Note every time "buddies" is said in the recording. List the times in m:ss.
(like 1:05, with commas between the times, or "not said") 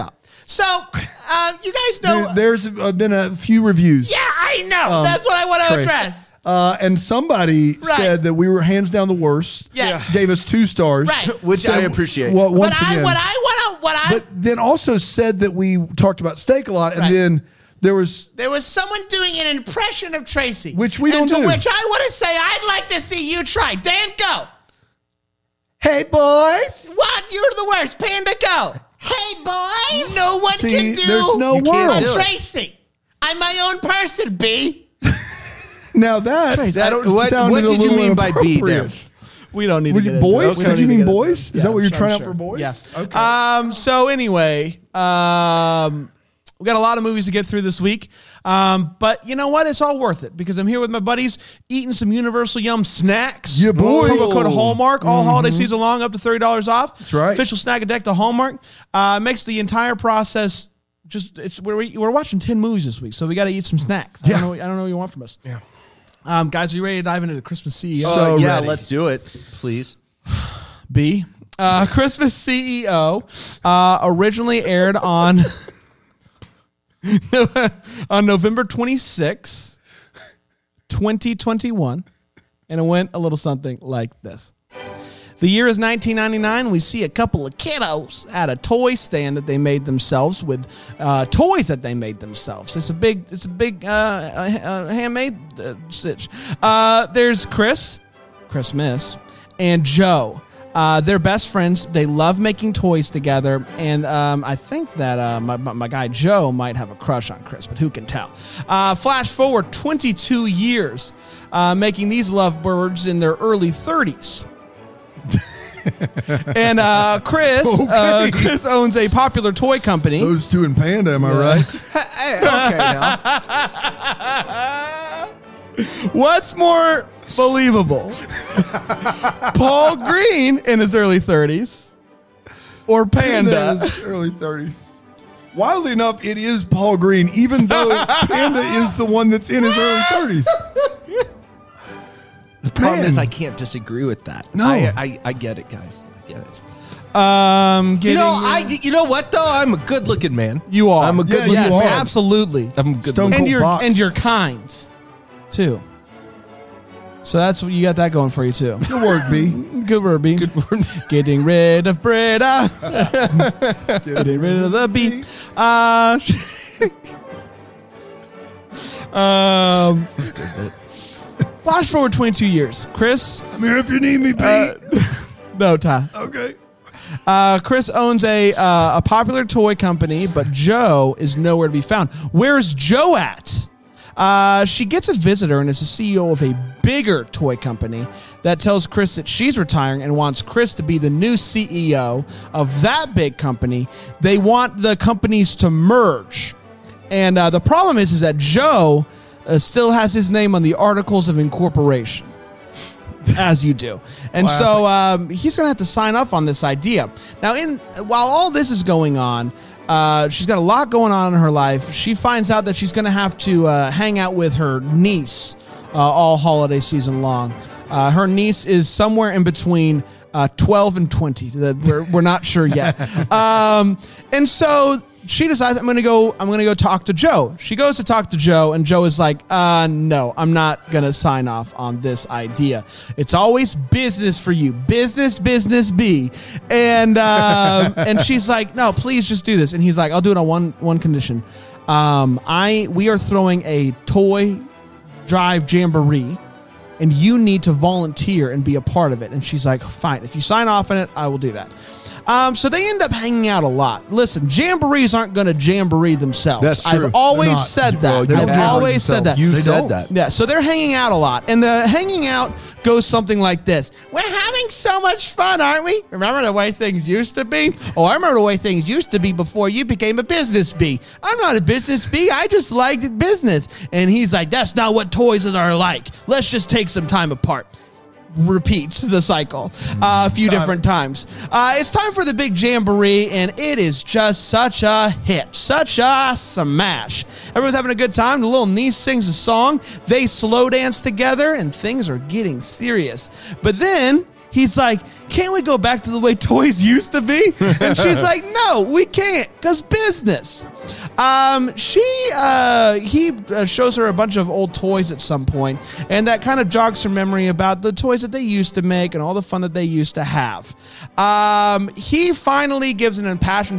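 0:50.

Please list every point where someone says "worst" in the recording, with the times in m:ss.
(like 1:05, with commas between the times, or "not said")
0:09, 0:27.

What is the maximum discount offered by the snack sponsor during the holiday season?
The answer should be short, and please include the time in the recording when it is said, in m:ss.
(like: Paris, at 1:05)
$30, at 0:56.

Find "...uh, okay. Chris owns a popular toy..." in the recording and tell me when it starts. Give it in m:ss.
1:57.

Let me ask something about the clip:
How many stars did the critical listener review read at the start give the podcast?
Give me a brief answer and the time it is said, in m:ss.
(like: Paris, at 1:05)
2, at 0:10.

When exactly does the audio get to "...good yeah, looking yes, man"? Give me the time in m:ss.
2:31.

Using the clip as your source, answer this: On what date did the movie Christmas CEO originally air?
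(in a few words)
November 26, 2021.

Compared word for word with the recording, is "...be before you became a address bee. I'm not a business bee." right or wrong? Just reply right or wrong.
wrong.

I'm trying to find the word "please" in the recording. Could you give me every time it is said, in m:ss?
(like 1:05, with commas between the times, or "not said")
1:09, 3:58.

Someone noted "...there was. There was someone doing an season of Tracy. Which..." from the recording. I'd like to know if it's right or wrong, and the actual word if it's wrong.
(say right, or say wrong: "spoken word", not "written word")
wrong: "impression", not "season".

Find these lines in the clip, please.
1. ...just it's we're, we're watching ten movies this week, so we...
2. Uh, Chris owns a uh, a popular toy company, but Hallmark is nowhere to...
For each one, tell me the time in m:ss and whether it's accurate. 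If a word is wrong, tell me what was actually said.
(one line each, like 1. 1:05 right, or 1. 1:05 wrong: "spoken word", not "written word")
1. 1:01 right
2. 2:57 wrong: "Joe", not "Hallmark".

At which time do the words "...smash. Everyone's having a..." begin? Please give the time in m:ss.
4:46.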